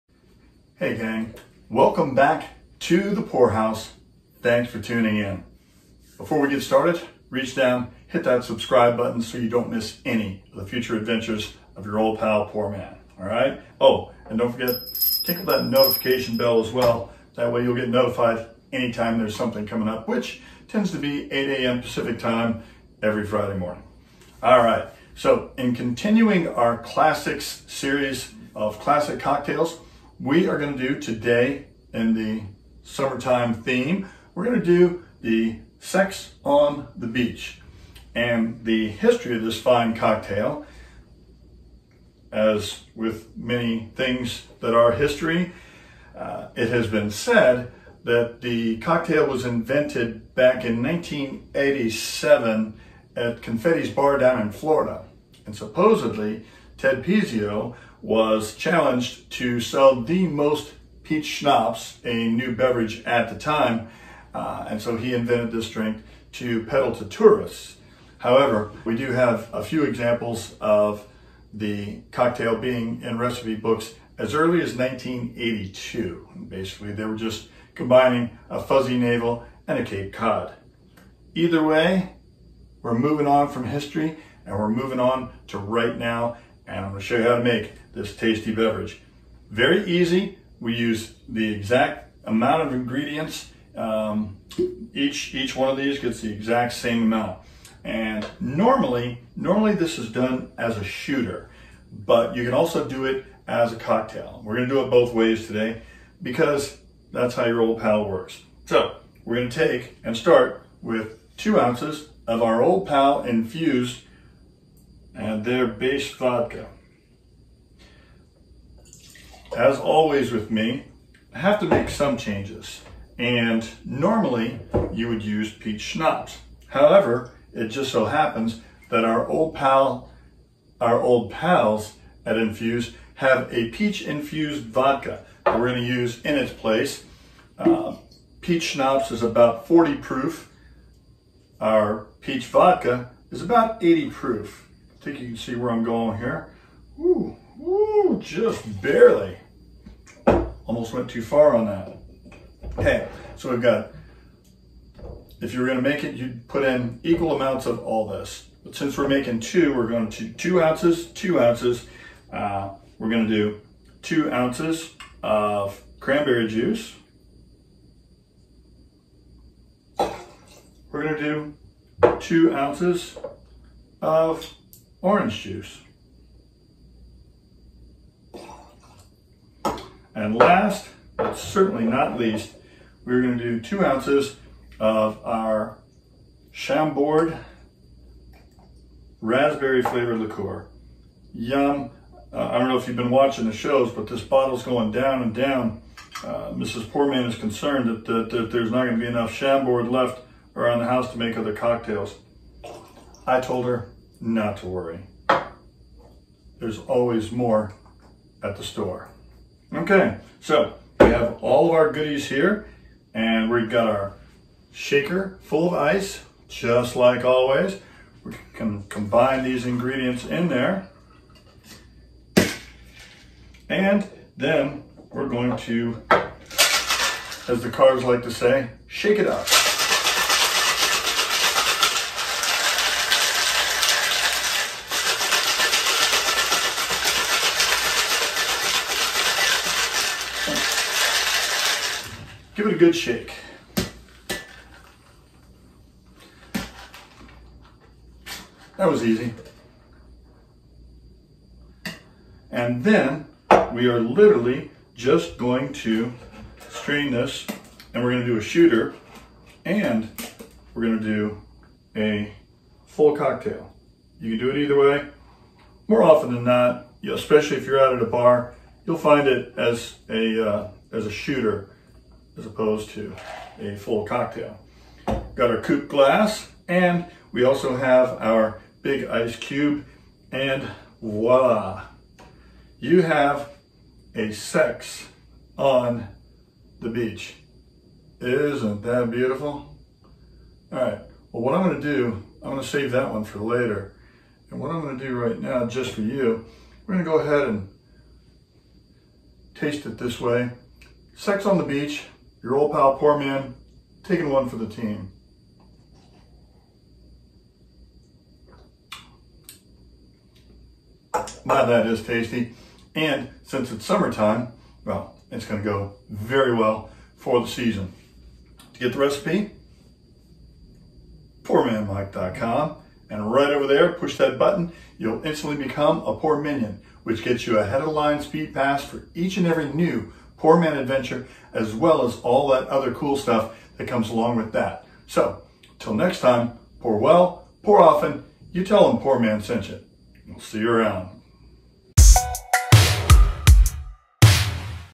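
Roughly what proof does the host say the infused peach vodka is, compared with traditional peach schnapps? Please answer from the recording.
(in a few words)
80 proof.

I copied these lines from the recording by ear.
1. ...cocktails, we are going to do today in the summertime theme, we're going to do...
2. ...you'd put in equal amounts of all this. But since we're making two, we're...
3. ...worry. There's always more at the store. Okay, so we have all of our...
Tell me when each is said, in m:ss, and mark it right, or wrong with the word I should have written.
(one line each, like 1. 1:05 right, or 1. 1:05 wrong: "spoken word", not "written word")
1. 0:29 right
2. 2:36 right
3. 3:24 right.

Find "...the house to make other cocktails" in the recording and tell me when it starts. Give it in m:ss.
3:20.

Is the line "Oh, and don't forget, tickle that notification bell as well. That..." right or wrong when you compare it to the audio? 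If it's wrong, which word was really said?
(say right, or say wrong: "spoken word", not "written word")
right.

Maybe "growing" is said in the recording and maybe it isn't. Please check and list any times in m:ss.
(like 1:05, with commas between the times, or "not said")
not said.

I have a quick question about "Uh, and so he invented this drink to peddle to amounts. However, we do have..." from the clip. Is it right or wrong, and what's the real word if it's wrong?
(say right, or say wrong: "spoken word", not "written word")
wrong: "tourists", not "amounts".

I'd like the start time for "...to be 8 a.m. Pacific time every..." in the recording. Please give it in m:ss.
0:20.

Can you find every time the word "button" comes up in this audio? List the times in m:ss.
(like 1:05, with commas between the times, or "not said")
0:08, 5:24.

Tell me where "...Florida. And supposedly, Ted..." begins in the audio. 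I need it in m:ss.
0:54.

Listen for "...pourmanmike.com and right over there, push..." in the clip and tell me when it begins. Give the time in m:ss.
5:21.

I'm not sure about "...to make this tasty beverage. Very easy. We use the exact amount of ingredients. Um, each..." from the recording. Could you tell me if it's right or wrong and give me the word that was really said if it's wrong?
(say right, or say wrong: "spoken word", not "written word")
right.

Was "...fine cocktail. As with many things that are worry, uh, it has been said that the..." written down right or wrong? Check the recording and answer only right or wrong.
wrong.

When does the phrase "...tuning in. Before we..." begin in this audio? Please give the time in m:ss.
0:04.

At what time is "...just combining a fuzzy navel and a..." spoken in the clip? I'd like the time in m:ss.
1:17.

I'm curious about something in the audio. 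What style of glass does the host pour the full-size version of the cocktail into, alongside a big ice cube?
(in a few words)
coupe glass.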